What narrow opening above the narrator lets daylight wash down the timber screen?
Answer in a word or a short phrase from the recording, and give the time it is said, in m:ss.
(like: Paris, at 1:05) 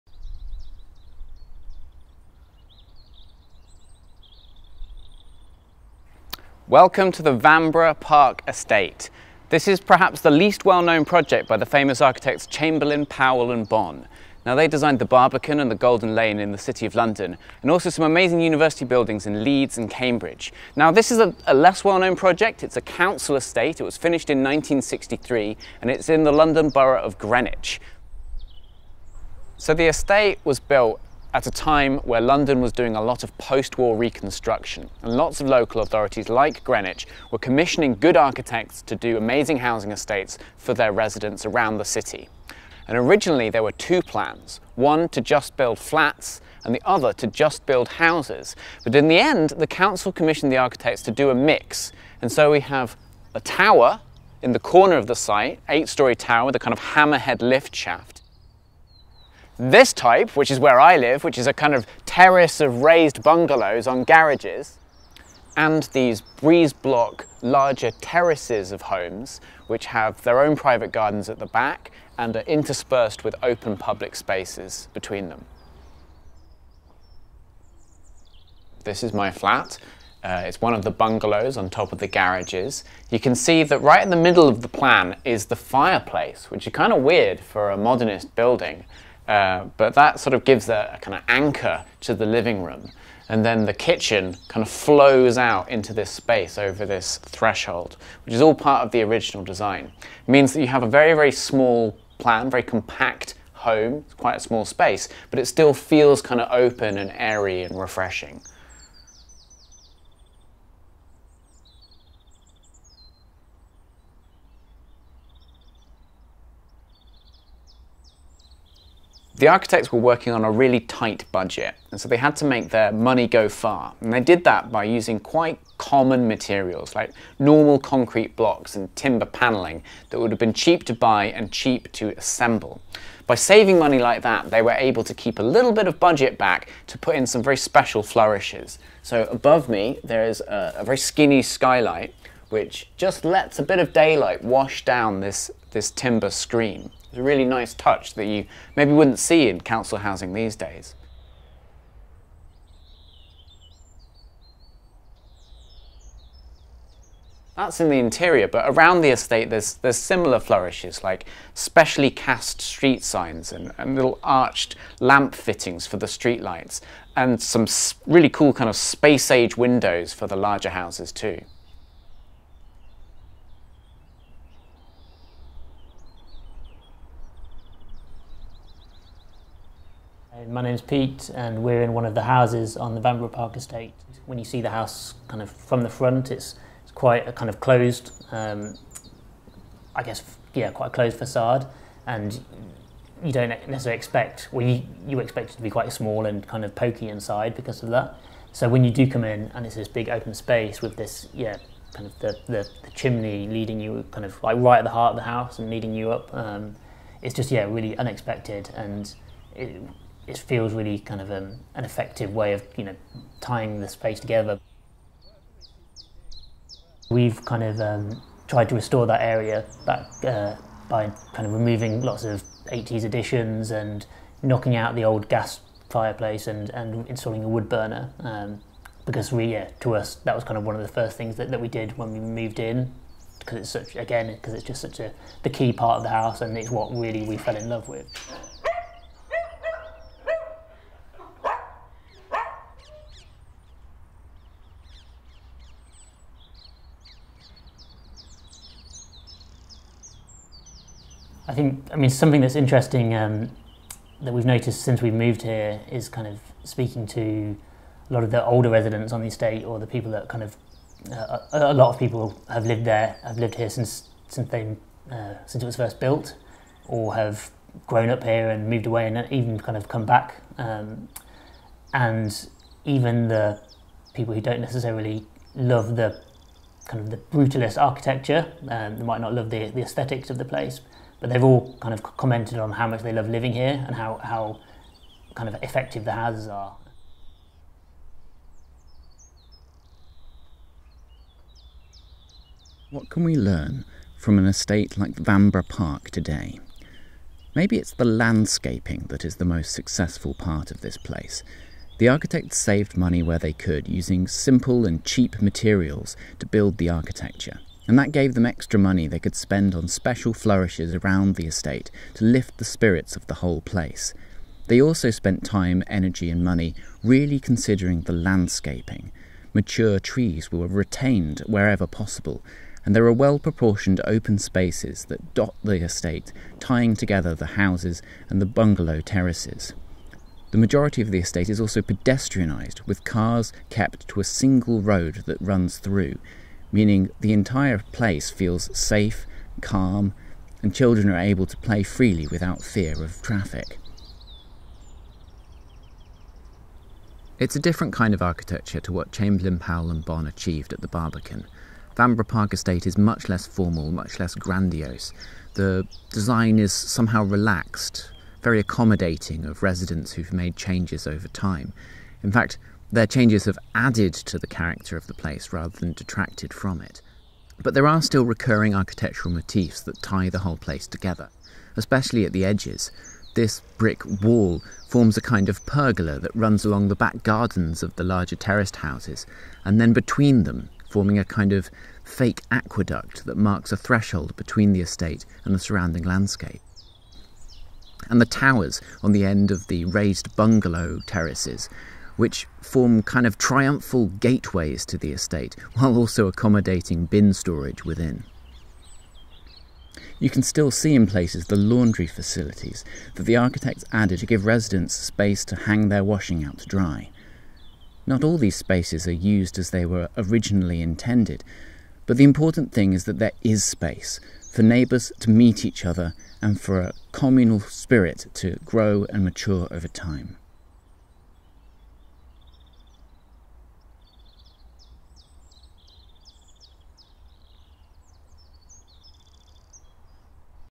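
Skylight, at 2:21.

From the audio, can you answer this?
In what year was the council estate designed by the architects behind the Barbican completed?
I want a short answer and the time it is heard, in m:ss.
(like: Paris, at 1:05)
1963, at 0:24.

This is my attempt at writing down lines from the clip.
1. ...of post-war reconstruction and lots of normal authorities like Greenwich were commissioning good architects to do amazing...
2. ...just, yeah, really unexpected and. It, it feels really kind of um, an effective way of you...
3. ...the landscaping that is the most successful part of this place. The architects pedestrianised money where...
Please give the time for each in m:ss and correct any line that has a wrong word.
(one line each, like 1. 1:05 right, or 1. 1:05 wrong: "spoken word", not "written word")
1. 0:33 wrong: "local", not "normal"
2. 3:27 right
3. 4:57 wrong: "saved", not "pedestrianised".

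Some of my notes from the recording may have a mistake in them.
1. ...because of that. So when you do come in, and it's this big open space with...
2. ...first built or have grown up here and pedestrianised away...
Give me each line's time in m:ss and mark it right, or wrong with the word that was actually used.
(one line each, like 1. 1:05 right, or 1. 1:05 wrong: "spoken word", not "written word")
1. 3:17 right
2. 4:25 wrong: "moved", not "pedestrianised".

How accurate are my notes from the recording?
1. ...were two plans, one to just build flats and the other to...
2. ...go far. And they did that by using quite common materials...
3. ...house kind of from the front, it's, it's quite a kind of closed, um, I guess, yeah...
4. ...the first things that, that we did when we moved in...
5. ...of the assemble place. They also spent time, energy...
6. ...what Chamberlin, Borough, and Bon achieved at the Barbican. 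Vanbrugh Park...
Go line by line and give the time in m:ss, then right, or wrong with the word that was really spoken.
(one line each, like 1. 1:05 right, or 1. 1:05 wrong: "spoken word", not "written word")
1. 0:43 right
2. 2:03 right
3. 3:04 right
4. 3:50 right
5. 5:13 wrong: "whole", not "assemble"
6. 5:48 wrong: "Powell", not "Borough".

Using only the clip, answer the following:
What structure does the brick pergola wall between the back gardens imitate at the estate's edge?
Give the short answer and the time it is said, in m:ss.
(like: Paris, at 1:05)
Aqueduct, at 6:22.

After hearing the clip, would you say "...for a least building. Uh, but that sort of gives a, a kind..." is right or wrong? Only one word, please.
wrong.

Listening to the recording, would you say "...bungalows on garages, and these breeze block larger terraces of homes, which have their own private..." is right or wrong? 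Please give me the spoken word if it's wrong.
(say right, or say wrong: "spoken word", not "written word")
right.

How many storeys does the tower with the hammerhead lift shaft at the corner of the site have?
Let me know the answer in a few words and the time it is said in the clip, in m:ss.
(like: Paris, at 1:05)
8, at 0:55.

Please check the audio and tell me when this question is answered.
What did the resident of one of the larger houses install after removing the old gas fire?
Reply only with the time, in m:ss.
3:47.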